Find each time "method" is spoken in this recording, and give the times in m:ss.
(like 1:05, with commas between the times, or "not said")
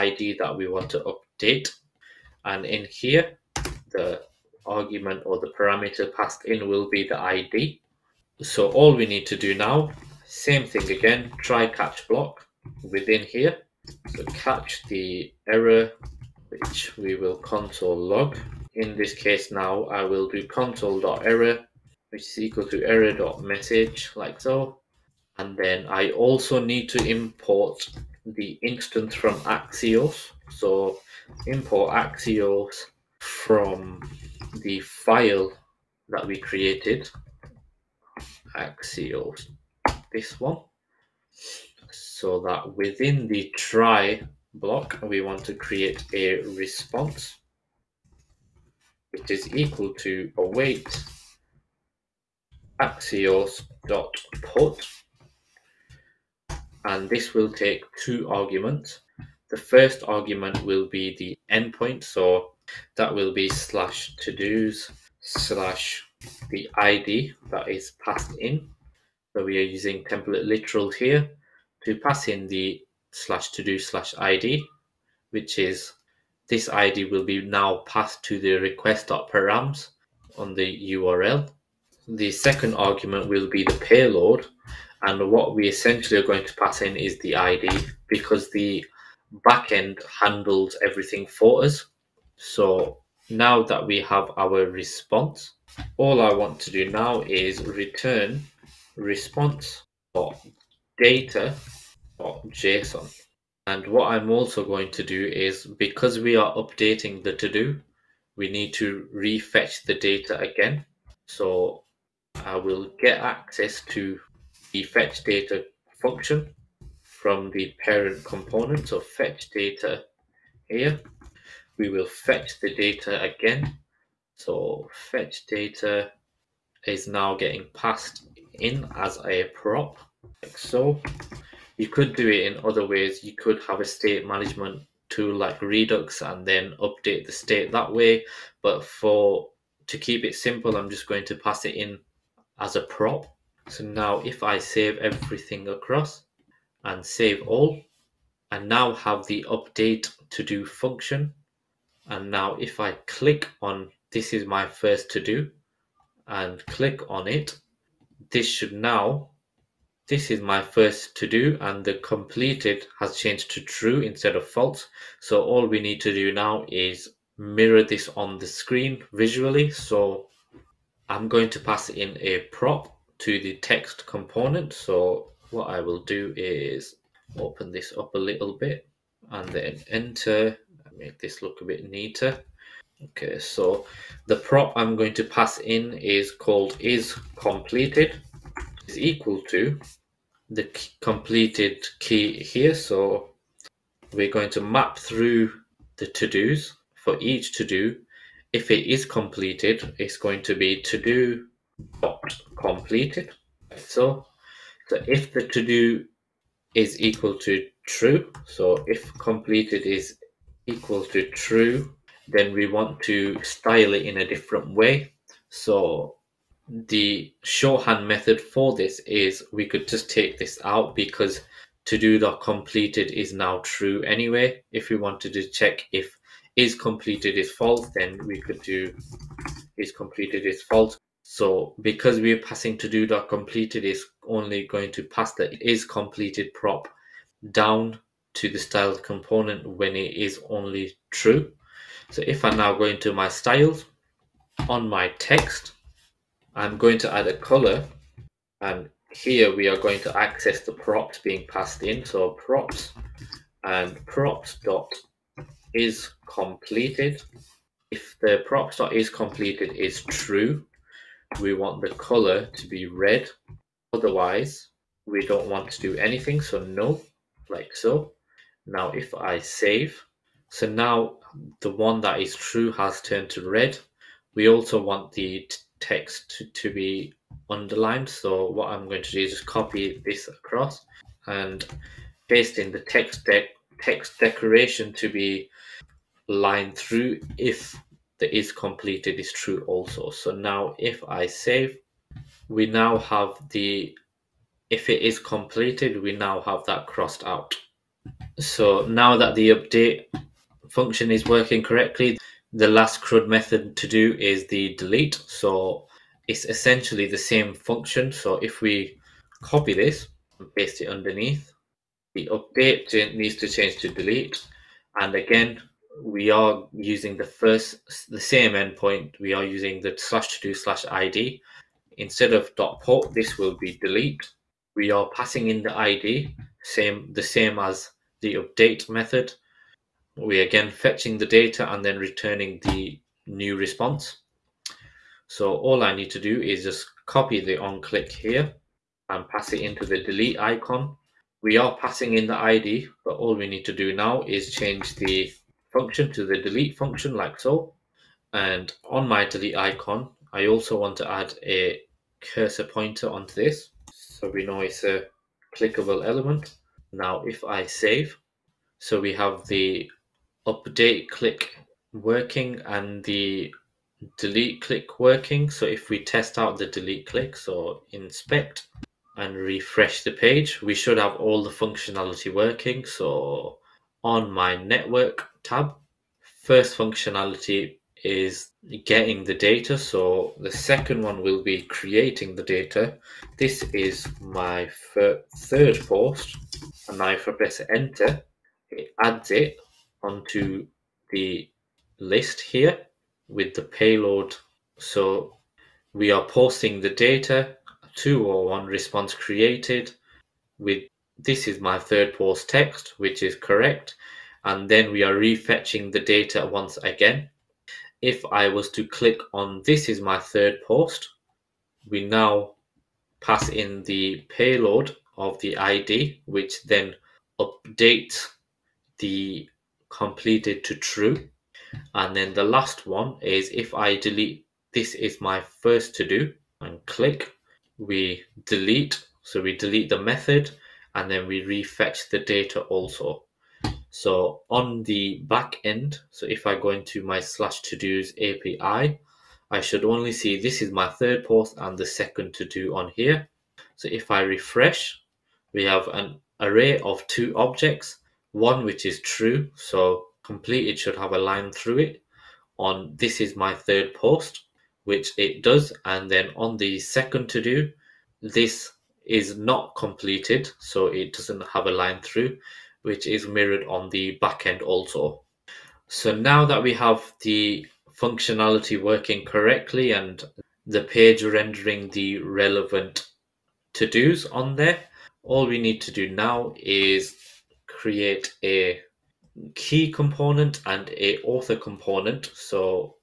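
3:38, 5:03, 5:28, 7:10.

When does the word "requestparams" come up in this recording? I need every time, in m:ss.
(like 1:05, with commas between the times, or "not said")
1:18.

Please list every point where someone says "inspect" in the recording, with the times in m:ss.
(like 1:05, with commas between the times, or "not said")
6:07.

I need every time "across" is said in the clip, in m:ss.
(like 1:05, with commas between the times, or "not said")
2:25, 4:40.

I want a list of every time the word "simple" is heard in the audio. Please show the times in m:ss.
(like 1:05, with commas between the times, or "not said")
2:20.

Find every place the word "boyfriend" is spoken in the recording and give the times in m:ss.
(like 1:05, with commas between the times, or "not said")
not said.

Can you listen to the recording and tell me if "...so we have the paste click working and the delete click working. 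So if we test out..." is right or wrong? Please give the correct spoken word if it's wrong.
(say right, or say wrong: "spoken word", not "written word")
wrong: "update", not "paste".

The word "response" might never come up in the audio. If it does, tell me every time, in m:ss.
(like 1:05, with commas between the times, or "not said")
0:46, 1:34, 1:38, 5:33, 6:38.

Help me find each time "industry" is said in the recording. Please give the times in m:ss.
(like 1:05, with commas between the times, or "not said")
not said.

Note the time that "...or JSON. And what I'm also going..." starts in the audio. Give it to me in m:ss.
1:42.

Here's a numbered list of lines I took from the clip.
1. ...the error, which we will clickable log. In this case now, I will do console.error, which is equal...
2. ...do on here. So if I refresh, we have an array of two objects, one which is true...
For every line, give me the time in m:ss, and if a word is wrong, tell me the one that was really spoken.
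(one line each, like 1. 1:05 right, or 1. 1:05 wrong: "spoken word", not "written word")
1. 0:14 wrong: "console", not "clickable"
2. 7:22 right.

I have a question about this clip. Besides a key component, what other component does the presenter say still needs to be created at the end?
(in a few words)
author component.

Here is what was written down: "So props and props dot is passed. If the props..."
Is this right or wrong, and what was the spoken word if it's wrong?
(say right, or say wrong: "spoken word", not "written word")
wrong: "completed", not "passed".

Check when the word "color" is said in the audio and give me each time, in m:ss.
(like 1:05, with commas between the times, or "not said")
4:07, 4:21.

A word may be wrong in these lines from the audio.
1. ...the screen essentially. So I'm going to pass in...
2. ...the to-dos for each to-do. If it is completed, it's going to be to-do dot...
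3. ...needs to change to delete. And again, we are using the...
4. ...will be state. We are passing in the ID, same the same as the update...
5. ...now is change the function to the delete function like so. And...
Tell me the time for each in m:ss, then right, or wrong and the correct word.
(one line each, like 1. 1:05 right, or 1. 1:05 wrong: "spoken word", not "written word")
1. 2:48 wrong: "visually", not "essentially"
2. 3:15 right
3. 5:13 right
4. 5:23 wrong: "delete", not "state"
5. 5:43 right.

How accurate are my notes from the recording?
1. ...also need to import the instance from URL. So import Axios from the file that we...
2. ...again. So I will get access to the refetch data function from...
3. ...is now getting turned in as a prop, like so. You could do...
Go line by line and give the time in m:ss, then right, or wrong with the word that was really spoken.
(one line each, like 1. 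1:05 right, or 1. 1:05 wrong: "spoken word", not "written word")
1. 0:26 wrong: "Axios", not "URL"
2. 1:50 wrong: "fetch", not "refetch"
3. 2:06 wrong: "passed", not "turned".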